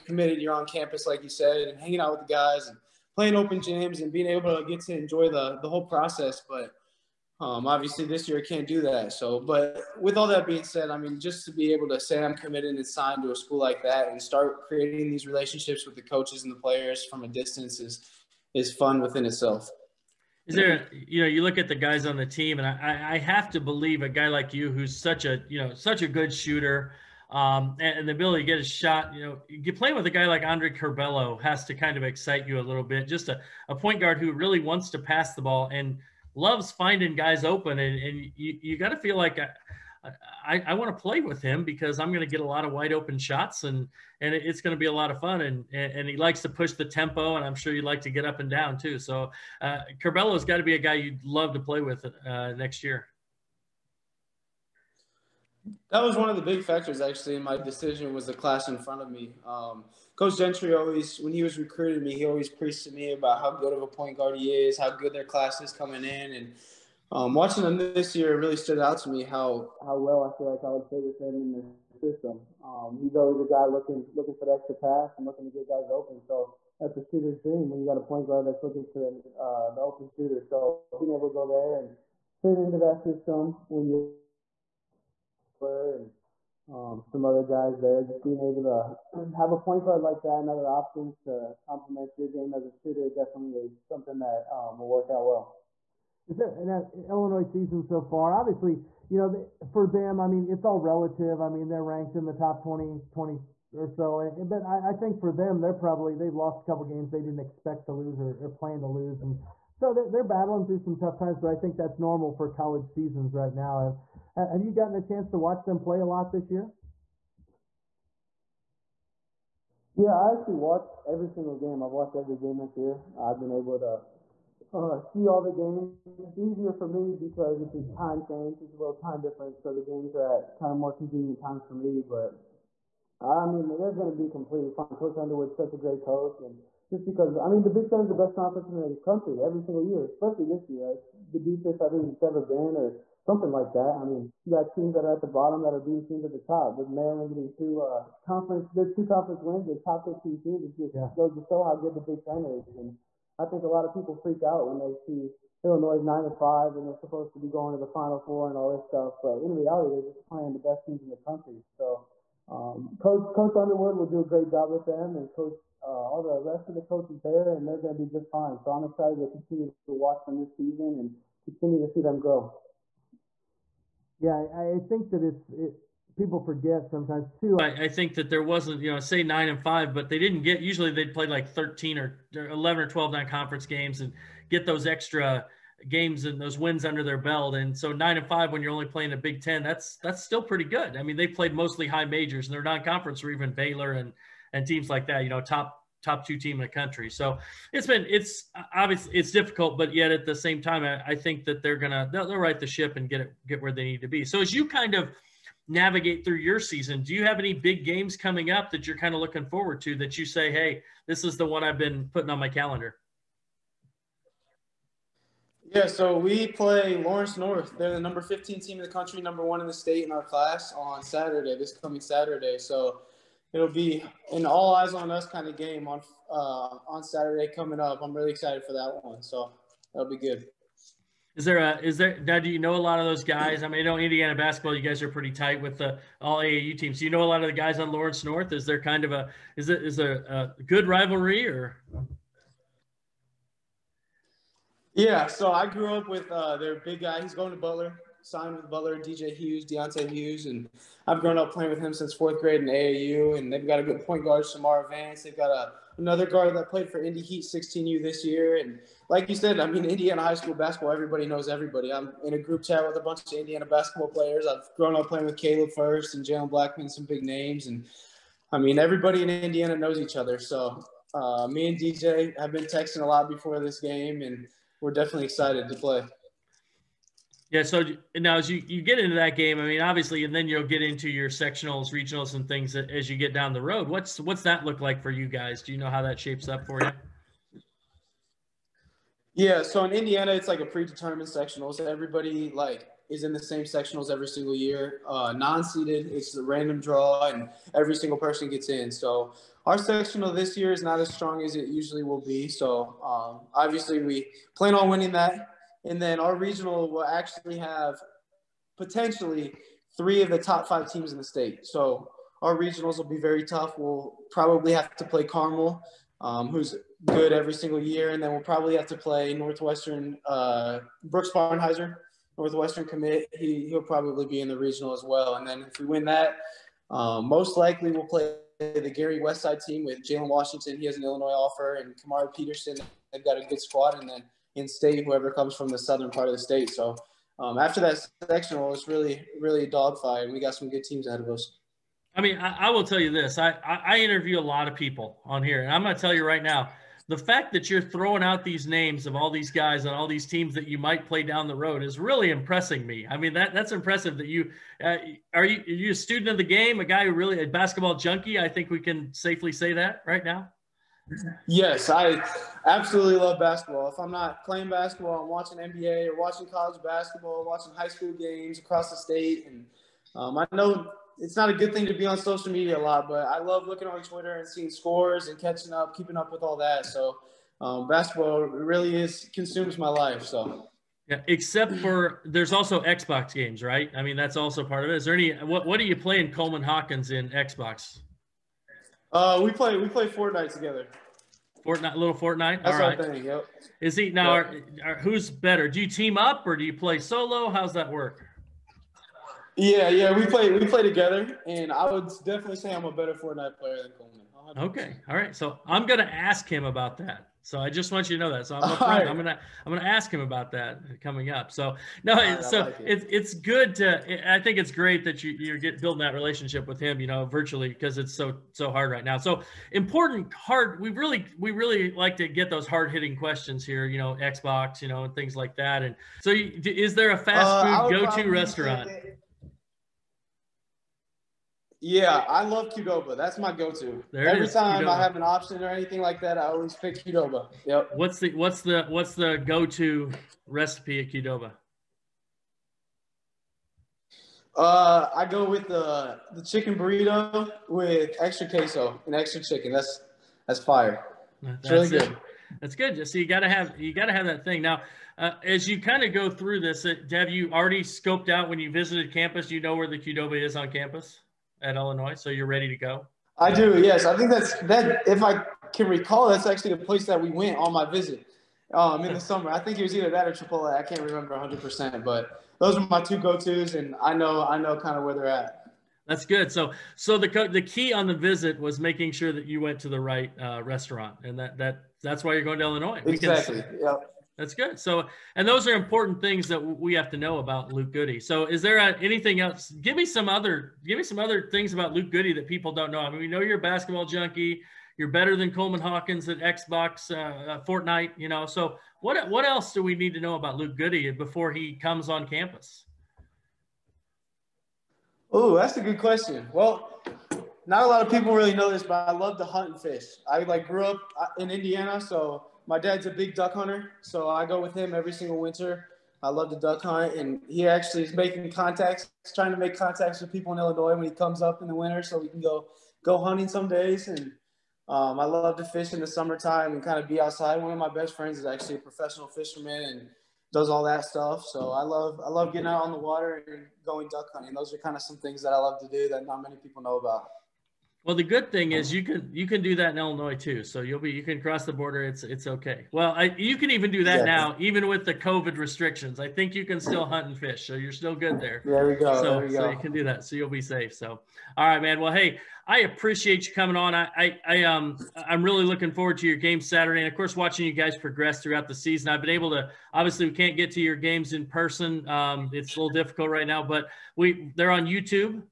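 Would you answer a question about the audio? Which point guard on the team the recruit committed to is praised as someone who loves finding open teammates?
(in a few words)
Andre Curbelo.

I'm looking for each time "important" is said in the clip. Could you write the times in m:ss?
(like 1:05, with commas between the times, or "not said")
6:59, 8:05.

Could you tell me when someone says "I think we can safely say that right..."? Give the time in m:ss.
5:58.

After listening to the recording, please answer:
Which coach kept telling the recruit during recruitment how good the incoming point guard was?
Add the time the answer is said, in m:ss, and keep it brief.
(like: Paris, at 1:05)
Coach Gentry, at 1:00.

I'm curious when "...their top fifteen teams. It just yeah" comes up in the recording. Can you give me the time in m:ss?
2:29.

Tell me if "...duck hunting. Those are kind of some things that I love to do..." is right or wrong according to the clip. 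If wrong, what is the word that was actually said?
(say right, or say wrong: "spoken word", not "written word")
right.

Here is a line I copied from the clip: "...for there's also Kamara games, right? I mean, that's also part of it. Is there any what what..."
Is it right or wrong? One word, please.
wrong.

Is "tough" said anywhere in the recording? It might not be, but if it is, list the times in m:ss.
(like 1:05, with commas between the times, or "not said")
1:50, 5:13.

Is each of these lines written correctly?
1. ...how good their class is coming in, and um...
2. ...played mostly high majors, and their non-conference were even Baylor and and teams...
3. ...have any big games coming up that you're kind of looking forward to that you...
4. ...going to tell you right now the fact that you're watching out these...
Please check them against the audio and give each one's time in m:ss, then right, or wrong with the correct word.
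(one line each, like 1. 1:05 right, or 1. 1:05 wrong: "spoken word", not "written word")
1. 1:04 right
2. 3:11 right
3. 3:27 right
4. 5:45 wrong: "throwing", not "watching".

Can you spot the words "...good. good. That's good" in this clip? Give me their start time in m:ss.
7:31.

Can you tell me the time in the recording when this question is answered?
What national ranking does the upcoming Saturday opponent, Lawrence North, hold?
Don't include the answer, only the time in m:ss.
3:37.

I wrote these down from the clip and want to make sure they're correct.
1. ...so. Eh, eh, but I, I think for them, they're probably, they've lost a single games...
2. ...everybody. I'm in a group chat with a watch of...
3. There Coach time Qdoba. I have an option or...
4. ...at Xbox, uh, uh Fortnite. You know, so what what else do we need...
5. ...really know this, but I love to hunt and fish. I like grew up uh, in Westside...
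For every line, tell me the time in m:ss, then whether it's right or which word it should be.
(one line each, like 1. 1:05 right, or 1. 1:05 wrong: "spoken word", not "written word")
1. 1:43 wrong: "couple", not "single"
2. 4:21 wrong: "bunch", not "watch"
3. 7:14 wrong: "Every", not "Coach"
4. 8:16 right
5. 8:28 wrong: "Indiana", not "Westside".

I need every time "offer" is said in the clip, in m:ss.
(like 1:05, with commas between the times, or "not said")
5:31.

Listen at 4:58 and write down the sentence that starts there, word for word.
So our sectional this year is not as strong as it usually will be.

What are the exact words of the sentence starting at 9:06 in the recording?
I think you can still hunt and fish, so you're still good there.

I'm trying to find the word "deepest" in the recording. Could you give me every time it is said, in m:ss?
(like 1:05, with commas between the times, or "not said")
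2:21.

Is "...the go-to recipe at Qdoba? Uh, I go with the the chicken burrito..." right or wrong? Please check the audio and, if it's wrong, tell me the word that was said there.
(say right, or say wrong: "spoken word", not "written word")
right.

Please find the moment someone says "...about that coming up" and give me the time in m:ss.
6:50.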